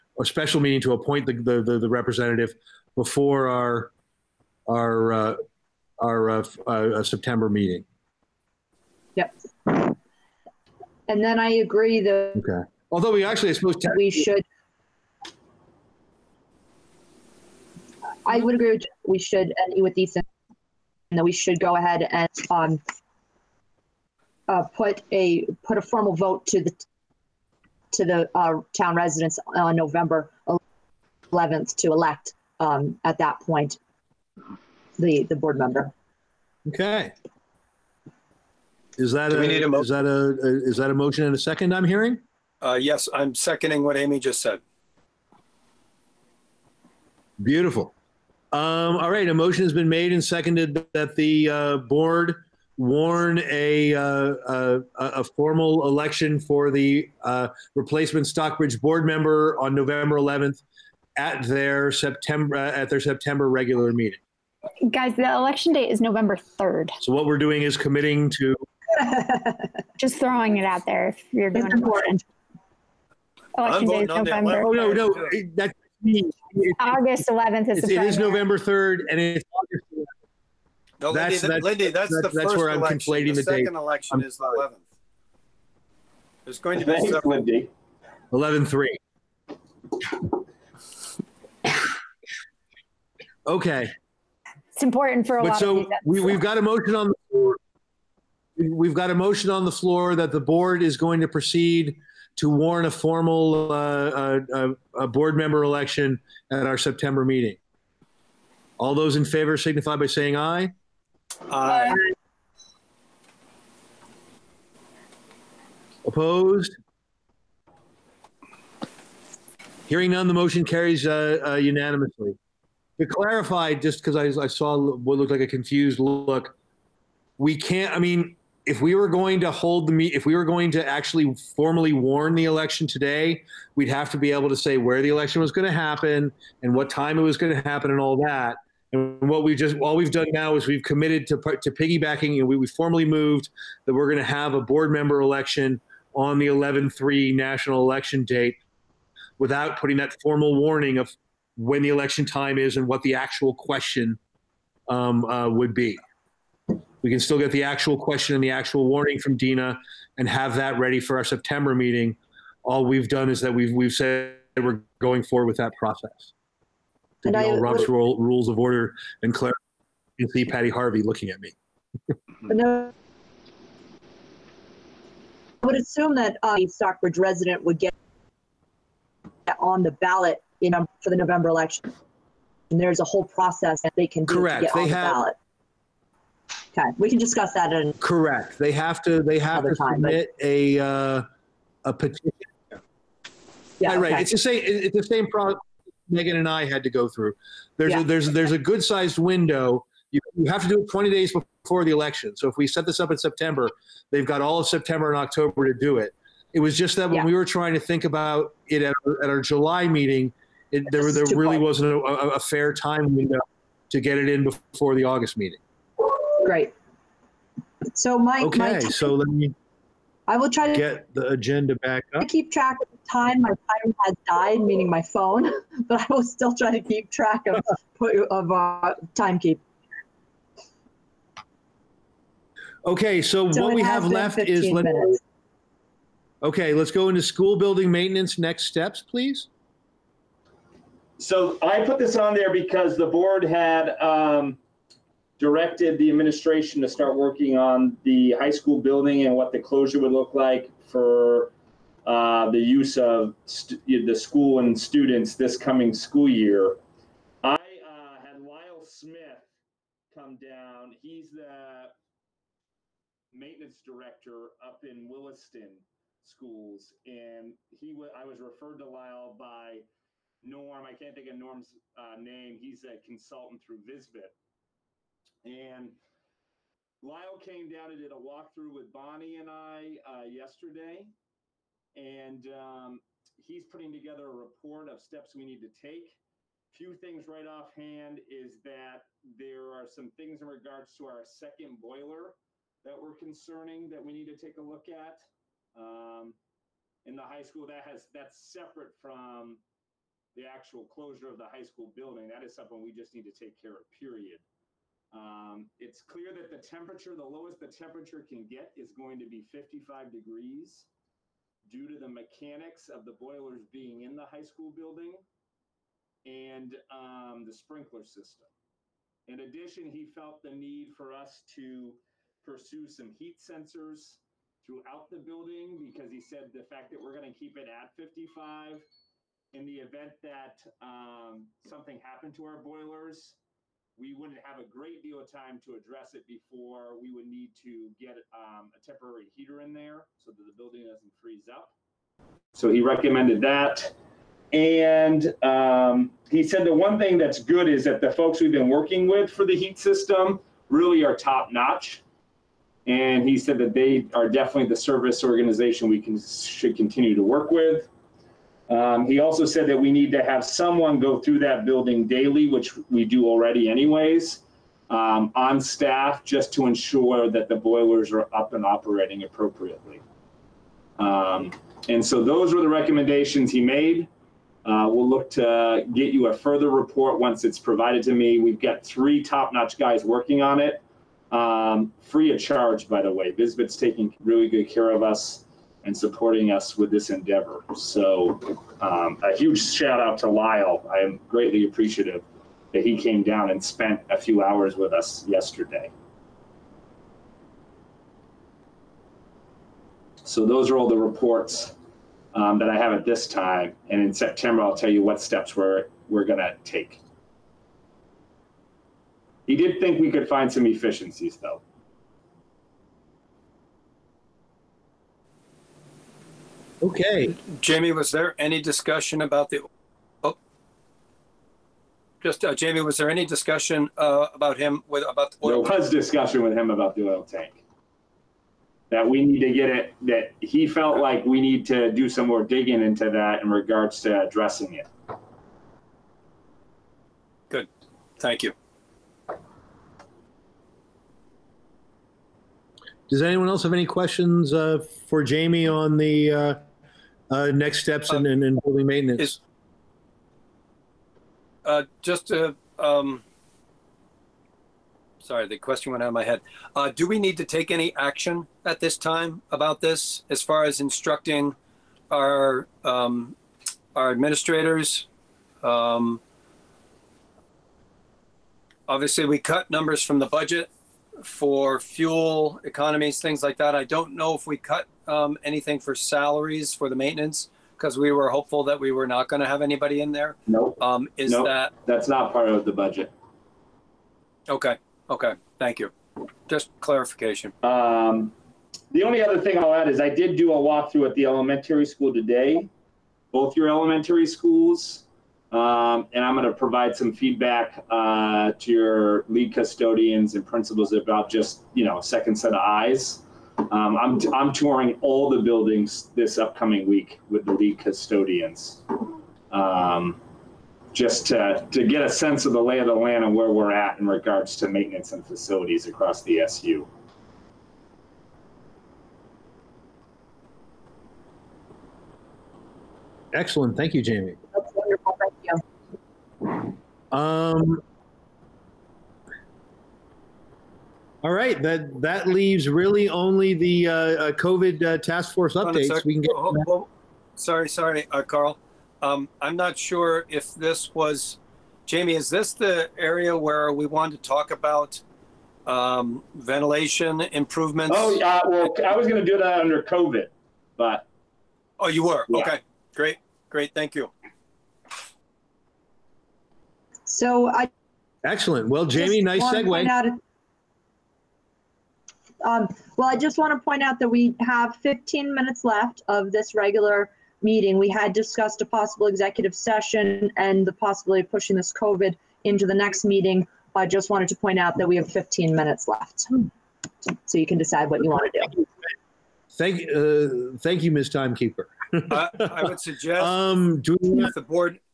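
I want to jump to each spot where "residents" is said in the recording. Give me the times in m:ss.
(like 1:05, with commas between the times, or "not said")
0:28, 2:57.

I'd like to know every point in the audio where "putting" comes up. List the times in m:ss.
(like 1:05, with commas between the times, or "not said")
2:29, 4:43.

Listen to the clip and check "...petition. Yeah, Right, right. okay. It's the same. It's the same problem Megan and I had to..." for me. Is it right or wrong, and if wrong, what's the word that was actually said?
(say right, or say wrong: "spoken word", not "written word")
right.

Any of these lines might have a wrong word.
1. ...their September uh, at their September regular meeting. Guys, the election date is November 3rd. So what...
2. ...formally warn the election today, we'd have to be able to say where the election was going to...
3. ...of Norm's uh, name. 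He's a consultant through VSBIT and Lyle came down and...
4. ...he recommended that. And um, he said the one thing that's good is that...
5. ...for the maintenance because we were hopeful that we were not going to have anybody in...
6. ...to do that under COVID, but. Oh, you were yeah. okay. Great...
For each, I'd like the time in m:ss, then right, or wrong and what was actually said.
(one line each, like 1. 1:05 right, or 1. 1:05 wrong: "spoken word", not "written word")
1. 1:01 right
2. 2:11 right
3. 4:31 right
4. 5:42 right
5. 7:56 right
6. 9:09 right.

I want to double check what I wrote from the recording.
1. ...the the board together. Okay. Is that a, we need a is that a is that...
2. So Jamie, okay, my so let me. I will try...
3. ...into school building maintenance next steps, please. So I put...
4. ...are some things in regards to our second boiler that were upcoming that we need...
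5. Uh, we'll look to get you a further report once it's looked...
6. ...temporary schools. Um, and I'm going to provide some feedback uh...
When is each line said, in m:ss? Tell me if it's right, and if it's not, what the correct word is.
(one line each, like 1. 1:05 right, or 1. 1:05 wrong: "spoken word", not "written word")
1. 0:34 wrong: "member", not "together"
2. 3:37 wrong: "Mike", not "Jamie"
3. 3:57 right
4. 4:49 wrong: "concerning", not "upcoming"
5. 6:14 wrong: "provided", not "looked"
6. 8:13 wrong: "elementary", not "temporary".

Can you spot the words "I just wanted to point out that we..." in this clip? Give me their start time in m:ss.
9:33.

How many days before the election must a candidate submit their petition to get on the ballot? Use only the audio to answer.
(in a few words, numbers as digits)
20.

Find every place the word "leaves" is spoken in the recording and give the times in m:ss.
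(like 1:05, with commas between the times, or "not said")
8:52.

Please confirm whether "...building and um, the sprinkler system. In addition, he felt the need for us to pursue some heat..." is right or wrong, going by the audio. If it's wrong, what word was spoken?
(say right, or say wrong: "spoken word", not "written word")
right.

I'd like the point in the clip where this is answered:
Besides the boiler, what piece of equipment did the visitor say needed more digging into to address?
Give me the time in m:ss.
7:07.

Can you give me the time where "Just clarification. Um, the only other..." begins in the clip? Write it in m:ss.
8:06.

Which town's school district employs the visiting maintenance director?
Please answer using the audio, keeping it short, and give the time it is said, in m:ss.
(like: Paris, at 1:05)
Williston, at 4:25.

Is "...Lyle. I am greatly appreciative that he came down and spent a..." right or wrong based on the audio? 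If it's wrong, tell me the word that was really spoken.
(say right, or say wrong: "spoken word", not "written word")
right.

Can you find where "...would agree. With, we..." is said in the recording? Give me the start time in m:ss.
0:18.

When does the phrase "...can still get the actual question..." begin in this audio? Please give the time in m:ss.
2:37.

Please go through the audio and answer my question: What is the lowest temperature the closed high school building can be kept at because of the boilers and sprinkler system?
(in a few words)
55 degrees.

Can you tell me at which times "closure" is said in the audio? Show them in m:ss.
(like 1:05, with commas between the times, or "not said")
4:09, 5:00.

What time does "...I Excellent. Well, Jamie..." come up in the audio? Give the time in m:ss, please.
9:17.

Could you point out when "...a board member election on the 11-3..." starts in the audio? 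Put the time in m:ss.
2:24.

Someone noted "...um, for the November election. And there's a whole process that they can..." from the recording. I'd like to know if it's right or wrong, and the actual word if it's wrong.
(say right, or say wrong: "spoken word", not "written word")
right.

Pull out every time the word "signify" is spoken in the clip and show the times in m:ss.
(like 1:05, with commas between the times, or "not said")
1:49.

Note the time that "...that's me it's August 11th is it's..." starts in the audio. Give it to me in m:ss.
1:15.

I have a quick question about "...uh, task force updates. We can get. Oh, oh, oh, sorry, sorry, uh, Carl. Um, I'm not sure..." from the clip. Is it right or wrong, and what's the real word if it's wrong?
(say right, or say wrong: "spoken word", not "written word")
right.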